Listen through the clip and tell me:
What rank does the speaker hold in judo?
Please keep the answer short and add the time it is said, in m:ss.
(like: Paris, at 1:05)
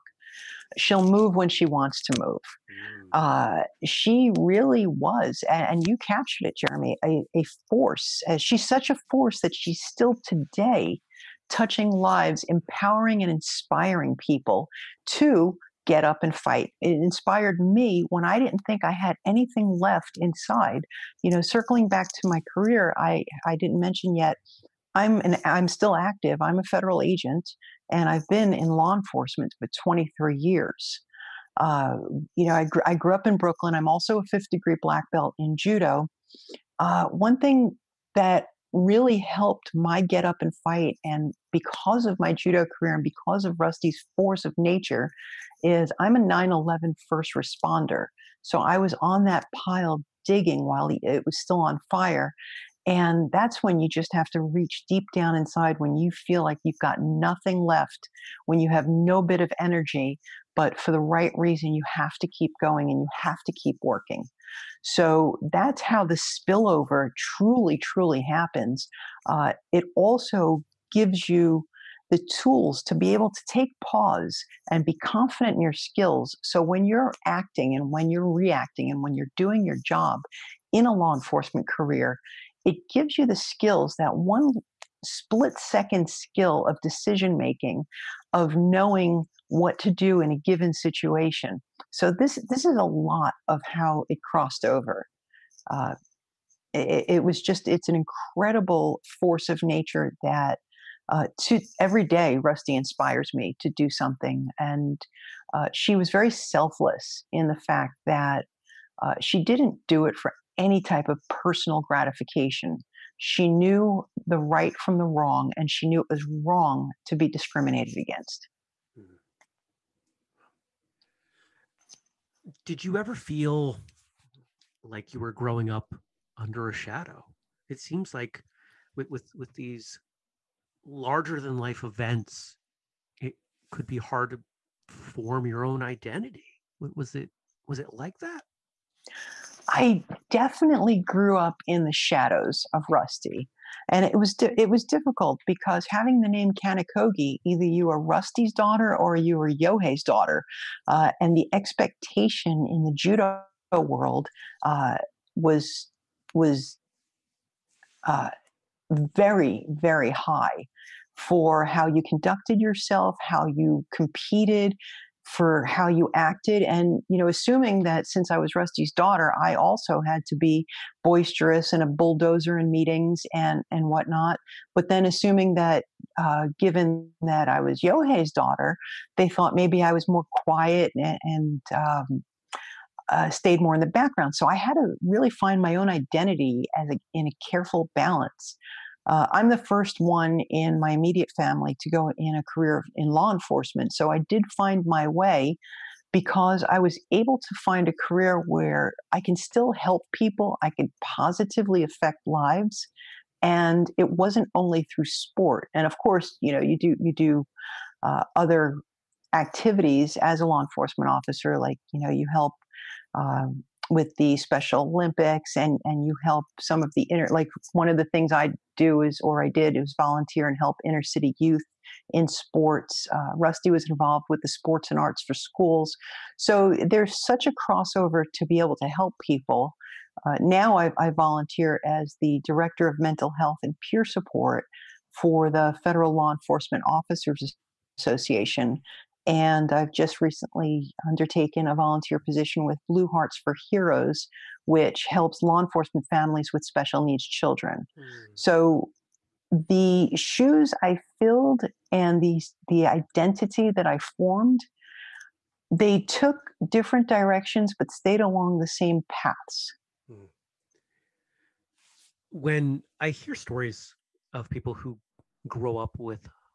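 Fifth degree black belt, at 0:34.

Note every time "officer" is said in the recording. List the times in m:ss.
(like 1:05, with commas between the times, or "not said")
3:31, 3:56.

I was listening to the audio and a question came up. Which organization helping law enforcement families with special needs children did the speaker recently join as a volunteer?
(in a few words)
Blue Hearts for Heroes.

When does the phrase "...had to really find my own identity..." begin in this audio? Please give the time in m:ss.
3:04.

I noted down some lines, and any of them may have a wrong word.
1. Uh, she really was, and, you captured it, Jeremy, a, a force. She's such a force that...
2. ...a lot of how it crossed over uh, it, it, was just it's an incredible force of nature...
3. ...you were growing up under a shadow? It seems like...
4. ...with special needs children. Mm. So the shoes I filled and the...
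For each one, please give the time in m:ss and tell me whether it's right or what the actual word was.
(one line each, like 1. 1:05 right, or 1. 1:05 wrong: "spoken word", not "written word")
1. 0:03 right
2. 1:32 right
3. 2:05 right
4. 4:06 right.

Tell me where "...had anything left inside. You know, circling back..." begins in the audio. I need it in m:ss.
0:18.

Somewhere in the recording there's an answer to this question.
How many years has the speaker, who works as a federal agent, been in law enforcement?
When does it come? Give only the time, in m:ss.
0:29.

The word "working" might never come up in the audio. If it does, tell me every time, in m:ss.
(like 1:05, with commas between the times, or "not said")
1:03.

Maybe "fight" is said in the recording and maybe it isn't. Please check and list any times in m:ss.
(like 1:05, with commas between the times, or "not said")
0:16, 0:40.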